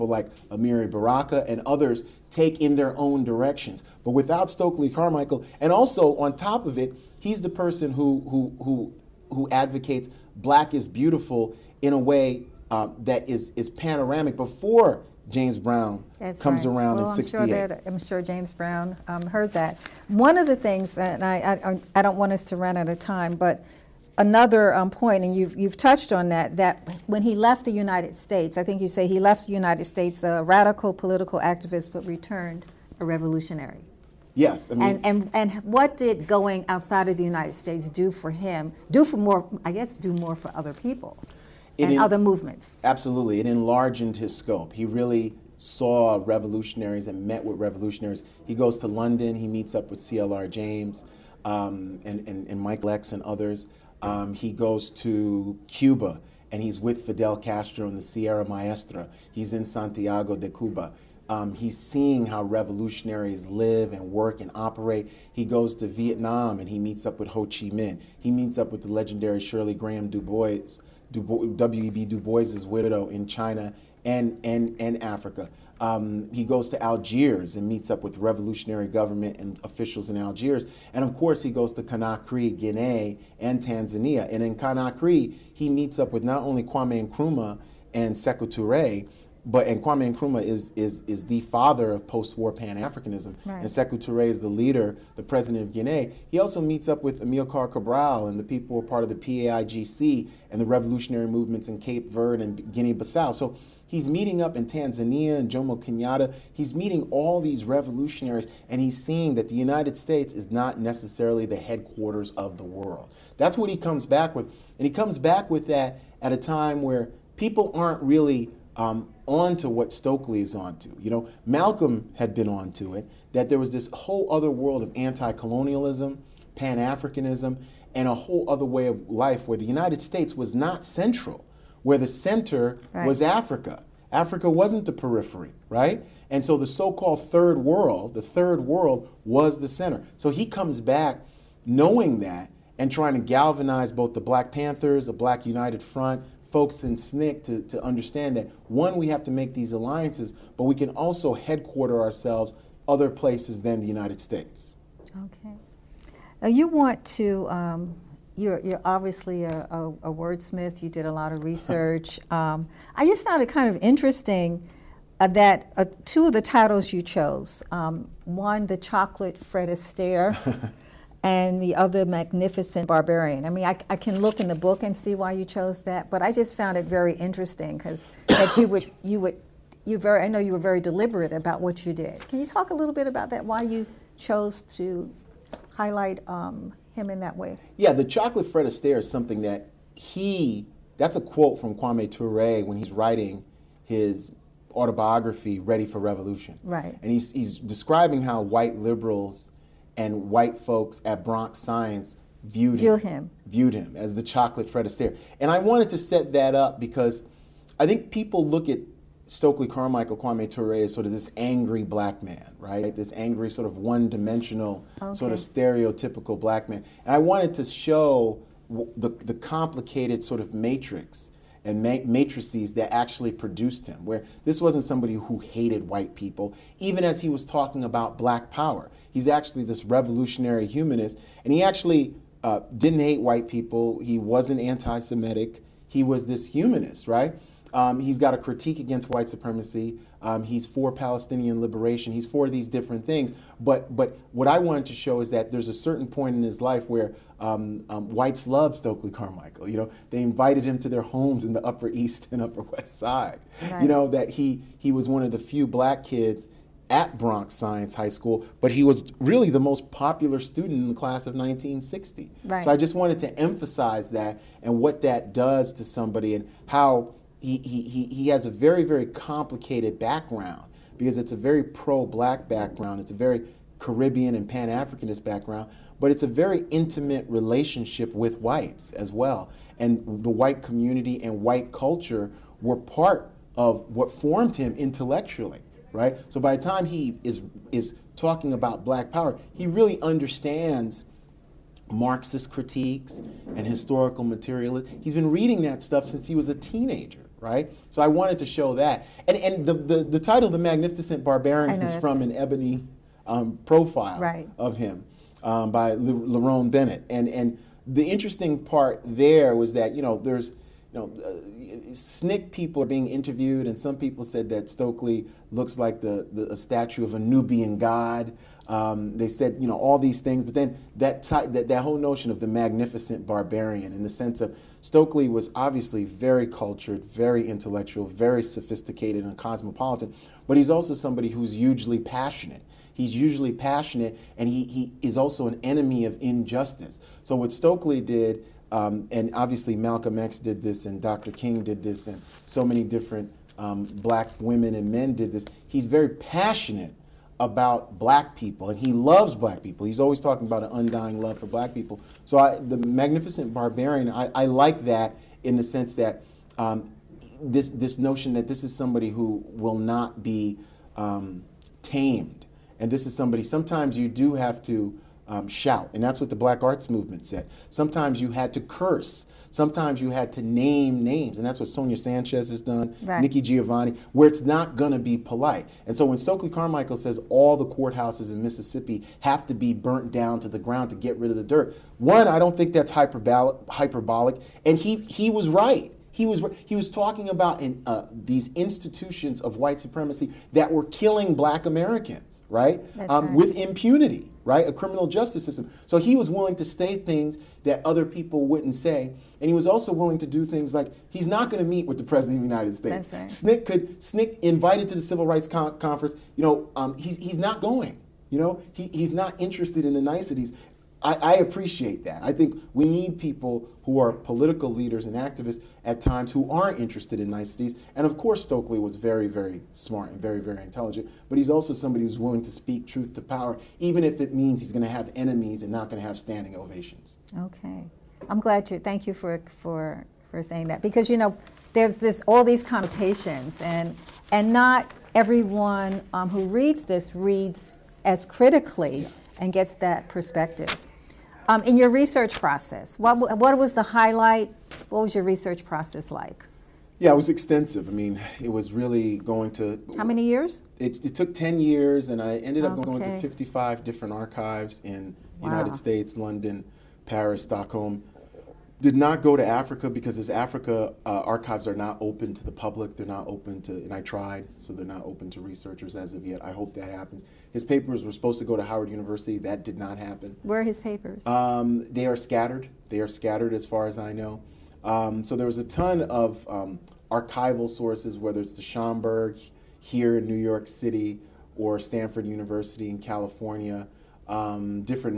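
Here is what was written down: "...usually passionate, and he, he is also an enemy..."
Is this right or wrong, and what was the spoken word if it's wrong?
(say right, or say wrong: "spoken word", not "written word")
right.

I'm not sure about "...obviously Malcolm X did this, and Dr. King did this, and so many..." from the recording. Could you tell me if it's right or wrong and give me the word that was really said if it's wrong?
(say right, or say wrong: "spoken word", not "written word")
right.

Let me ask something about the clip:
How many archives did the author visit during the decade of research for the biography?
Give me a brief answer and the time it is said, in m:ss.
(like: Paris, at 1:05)
55, at 7:33.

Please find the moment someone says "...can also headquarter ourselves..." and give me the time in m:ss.
2:30.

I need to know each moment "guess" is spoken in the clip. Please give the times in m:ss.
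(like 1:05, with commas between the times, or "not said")
0:39.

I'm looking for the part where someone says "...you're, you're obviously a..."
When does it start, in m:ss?
2:38.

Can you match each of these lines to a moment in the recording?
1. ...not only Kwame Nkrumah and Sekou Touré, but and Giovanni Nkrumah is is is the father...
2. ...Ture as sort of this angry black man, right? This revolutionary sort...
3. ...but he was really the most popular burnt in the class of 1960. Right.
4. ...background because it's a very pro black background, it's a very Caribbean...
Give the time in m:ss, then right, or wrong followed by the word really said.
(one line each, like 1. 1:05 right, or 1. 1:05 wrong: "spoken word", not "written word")
1. 1:26 wrong: "Kwame", not "Giovanni"
2. 3:30 wrong: "angry", not "revolutionary"
3. 4:18 wrong: "student", not "burnt"
4. 4:29 right.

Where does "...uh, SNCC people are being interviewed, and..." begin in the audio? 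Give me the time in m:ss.
5:11.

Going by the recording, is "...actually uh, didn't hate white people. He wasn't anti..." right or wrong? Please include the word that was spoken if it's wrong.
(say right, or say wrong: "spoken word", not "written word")
right.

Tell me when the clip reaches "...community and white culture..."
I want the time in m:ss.
4:40.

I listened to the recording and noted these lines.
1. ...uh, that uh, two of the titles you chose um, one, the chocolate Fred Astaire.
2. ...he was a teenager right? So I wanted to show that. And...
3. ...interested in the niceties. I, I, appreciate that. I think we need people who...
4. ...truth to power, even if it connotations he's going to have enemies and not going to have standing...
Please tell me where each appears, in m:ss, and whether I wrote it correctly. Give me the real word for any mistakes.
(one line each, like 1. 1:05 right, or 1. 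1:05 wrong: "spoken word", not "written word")
1. 2:45 right
2. 4:56 right
3. 6:49 right
4. 7:02 wrong: "means", not "connotations".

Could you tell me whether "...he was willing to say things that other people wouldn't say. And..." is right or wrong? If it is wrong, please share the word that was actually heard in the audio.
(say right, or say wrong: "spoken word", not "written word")
right.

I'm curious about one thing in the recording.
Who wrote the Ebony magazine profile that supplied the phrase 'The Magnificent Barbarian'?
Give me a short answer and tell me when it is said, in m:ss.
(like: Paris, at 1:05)
Lerone Bennett, at 5:05.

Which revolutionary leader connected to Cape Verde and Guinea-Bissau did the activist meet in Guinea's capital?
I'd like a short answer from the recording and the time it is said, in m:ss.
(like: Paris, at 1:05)
Amilcar Cabral, at 1:37.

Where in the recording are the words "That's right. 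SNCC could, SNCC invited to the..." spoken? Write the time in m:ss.
6:43.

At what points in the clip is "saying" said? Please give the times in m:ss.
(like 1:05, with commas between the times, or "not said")
7:10.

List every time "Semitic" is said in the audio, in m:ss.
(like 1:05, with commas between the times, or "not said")
3:54.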